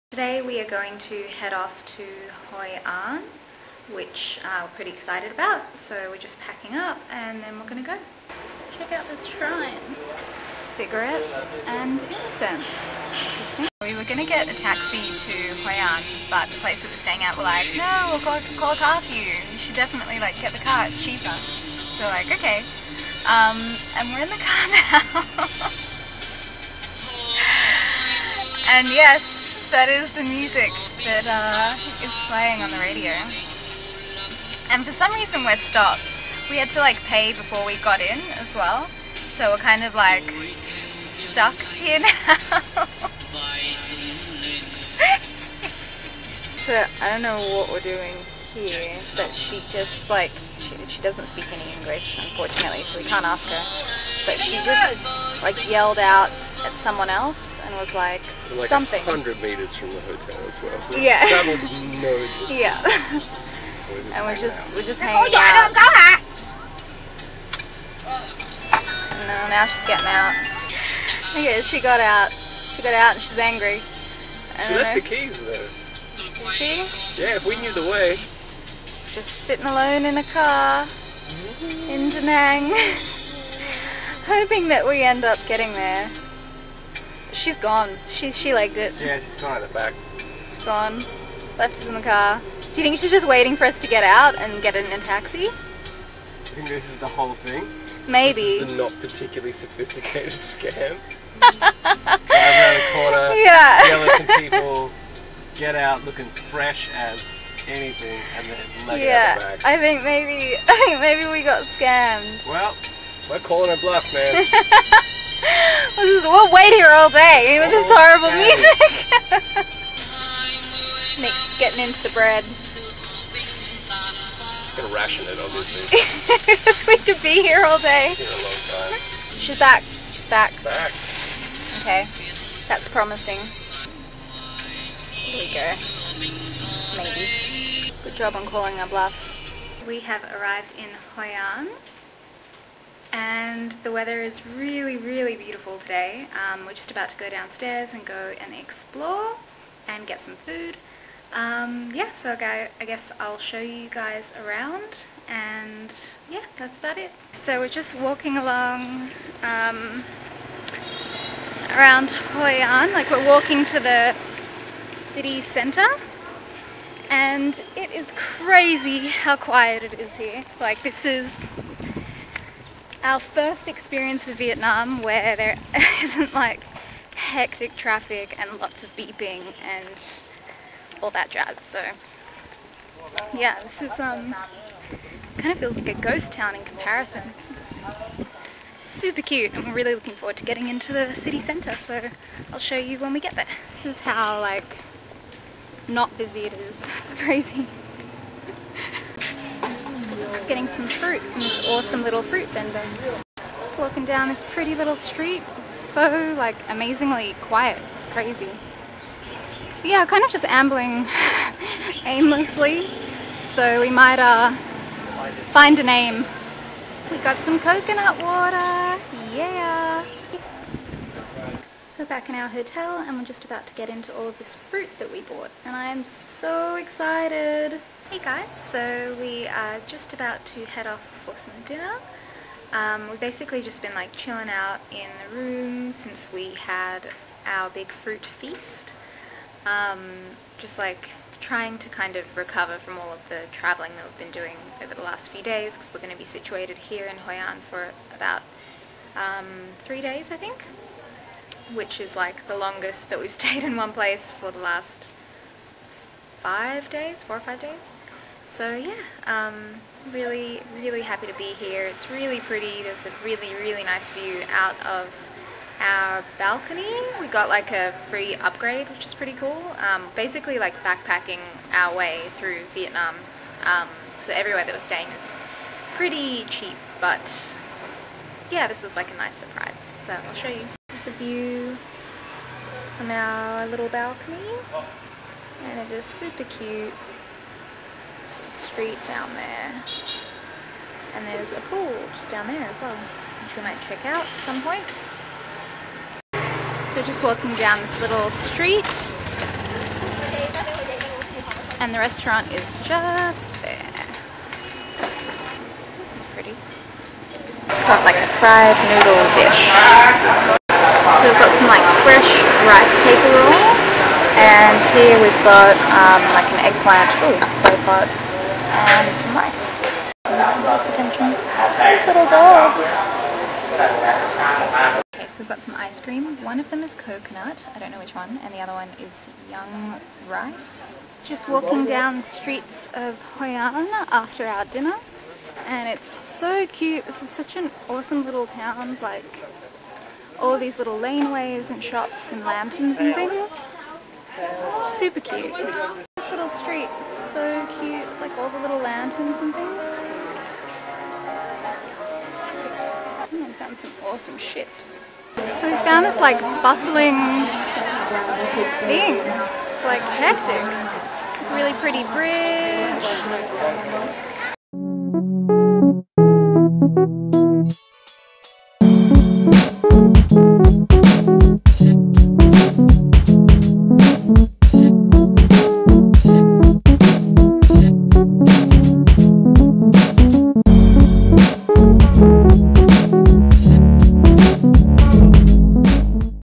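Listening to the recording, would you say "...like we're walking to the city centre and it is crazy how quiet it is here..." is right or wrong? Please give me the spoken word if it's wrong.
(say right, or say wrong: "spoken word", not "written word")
right.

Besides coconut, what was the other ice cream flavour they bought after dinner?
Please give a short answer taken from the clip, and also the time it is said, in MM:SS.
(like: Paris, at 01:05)
Young rice, at 05:29.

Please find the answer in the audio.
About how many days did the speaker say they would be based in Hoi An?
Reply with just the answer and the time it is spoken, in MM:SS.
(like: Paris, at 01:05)
3, at 04:09.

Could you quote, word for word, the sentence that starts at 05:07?
It's called like a fried noodle dish.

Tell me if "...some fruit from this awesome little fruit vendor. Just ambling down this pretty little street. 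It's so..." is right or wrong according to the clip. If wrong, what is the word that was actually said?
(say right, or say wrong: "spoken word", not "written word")
wrong: "walking", not "ambling".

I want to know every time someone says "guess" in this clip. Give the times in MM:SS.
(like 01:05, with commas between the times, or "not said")
02:32.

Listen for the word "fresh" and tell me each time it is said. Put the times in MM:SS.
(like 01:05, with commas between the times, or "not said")
01:46, 05:12.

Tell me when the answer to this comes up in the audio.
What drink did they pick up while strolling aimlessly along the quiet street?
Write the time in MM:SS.
03:37.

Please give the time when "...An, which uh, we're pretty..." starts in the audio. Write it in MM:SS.
00:02.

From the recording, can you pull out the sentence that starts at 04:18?
So yeah, um, really, really happy to be here.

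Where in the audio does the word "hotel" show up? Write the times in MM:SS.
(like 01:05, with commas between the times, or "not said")
01:00, 03:42.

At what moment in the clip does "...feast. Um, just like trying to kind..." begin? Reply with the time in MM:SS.
03:58.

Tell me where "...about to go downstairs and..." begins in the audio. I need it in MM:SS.
02:26.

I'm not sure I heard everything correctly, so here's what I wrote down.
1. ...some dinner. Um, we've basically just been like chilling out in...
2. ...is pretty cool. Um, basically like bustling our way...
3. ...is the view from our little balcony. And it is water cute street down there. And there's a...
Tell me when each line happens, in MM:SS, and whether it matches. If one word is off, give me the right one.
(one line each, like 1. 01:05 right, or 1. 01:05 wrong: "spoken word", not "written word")
1. 03:51 right
2. 04:29 wrong: "backpacking", not "bustling"
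3. 04:40 wrong: "super", not "water".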